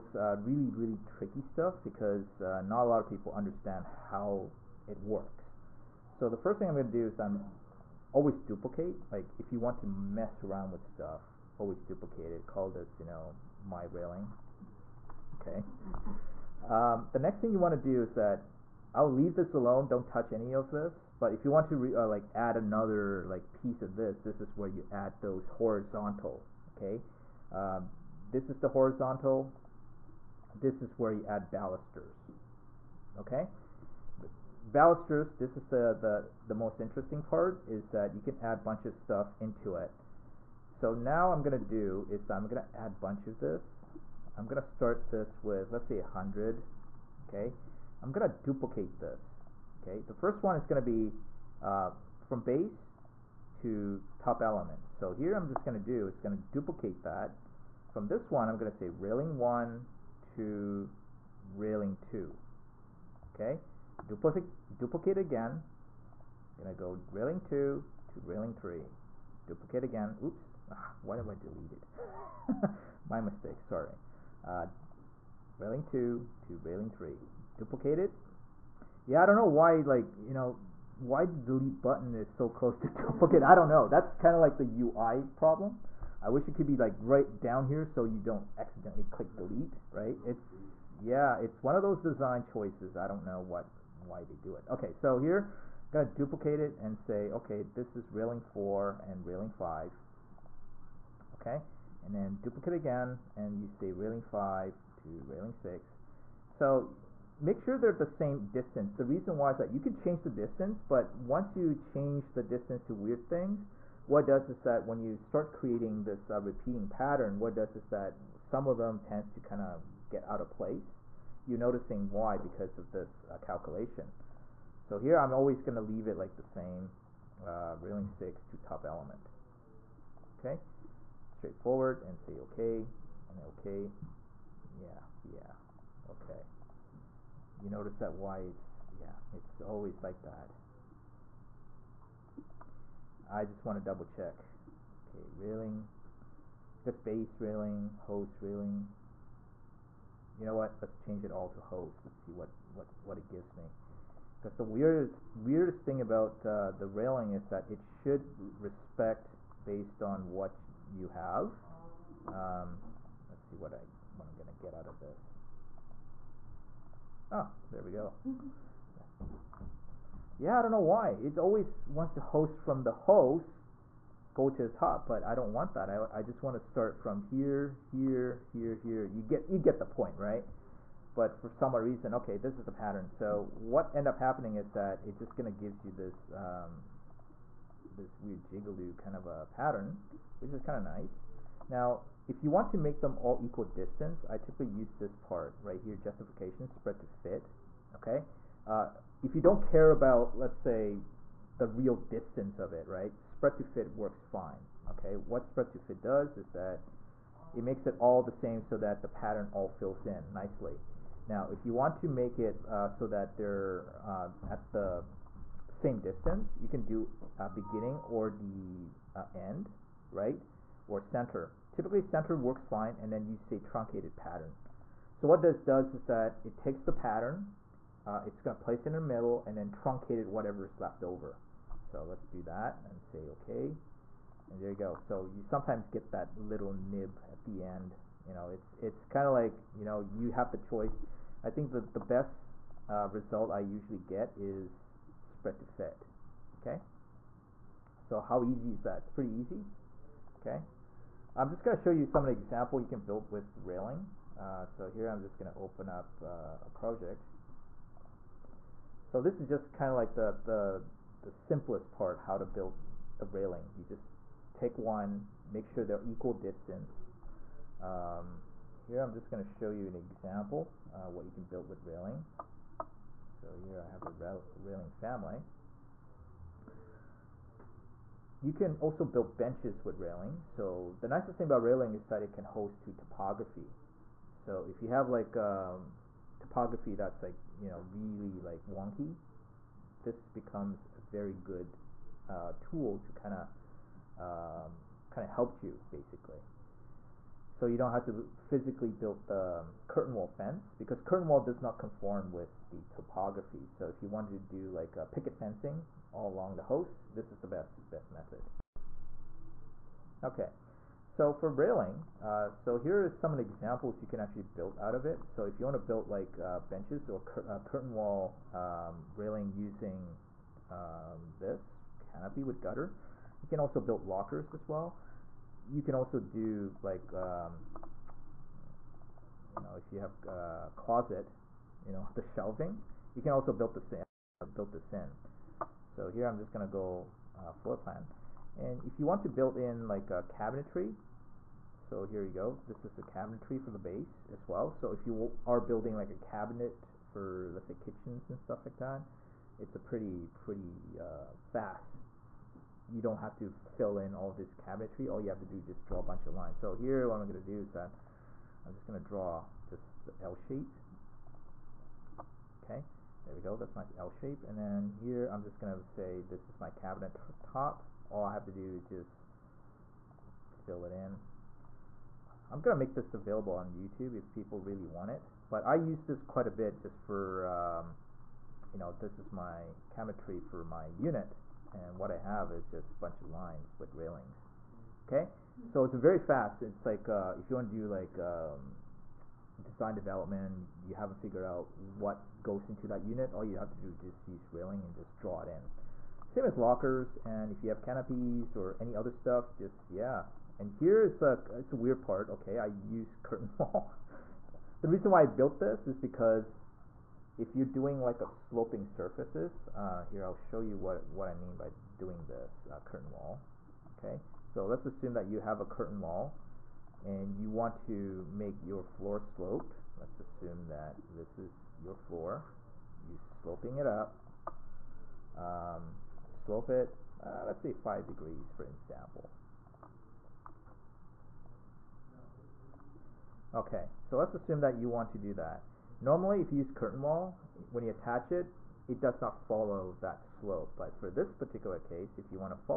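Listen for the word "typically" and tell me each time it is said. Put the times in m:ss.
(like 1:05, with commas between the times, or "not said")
3:14, 3:41.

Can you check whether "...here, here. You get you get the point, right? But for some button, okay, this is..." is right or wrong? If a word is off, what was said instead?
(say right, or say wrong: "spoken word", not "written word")
wrong: "reason", not "button".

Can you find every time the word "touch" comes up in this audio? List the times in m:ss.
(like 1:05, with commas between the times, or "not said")
0:20.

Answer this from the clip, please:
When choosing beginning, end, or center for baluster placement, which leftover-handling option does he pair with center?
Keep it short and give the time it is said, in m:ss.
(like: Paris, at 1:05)
Truncated pattern, at 3:43.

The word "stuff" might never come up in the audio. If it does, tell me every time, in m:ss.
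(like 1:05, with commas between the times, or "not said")
0:01, 0:10, 0:38, 5:48, 6:39.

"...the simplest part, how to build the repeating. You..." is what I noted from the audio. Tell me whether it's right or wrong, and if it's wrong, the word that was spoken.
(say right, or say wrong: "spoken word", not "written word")
wrong: "railing", not "repeating".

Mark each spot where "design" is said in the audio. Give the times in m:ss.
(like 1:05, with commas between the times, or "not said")
1:32, 6:29.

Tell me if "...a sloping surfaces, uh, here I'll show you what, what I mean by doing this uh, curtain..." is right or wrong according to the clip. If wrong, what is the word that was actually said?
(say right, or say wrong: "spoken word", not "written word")
right.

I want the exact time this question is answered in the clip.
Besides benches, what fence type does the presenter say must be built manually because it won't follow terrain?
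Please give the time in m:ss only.
4:59.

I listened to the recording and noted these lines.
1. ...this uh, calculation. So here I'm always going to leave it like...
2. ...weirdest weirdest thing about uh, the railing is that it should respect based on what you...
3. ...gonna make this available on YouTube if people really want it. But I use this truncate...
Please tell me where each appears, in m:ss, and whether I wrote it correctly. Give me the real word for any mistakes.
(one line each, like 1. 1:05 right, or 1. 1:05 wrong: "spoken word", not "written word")
1. 2:02 right
2. 2:34 right
3. 6:12 wrong: "quite", not "truncate".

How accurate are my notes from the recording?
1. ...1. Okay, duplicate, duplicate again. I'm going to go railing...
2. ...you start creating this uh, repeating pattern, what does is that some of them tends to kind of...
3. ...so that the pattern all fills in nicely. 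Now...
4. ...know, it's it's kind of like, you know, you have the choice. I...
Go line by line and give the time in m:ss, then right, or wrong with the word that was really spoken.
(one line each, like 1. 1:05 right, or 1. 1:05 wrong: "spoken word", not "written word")
1. 1:02 wrong: "2", not "1"
2. 1:54 right
3. 3:28 right
4. 3:58 right.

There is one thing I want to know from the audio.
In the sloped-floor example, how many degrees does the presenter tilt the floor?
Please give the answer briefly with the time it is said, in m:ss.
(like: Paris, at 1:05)
5 degrees, at 7:07.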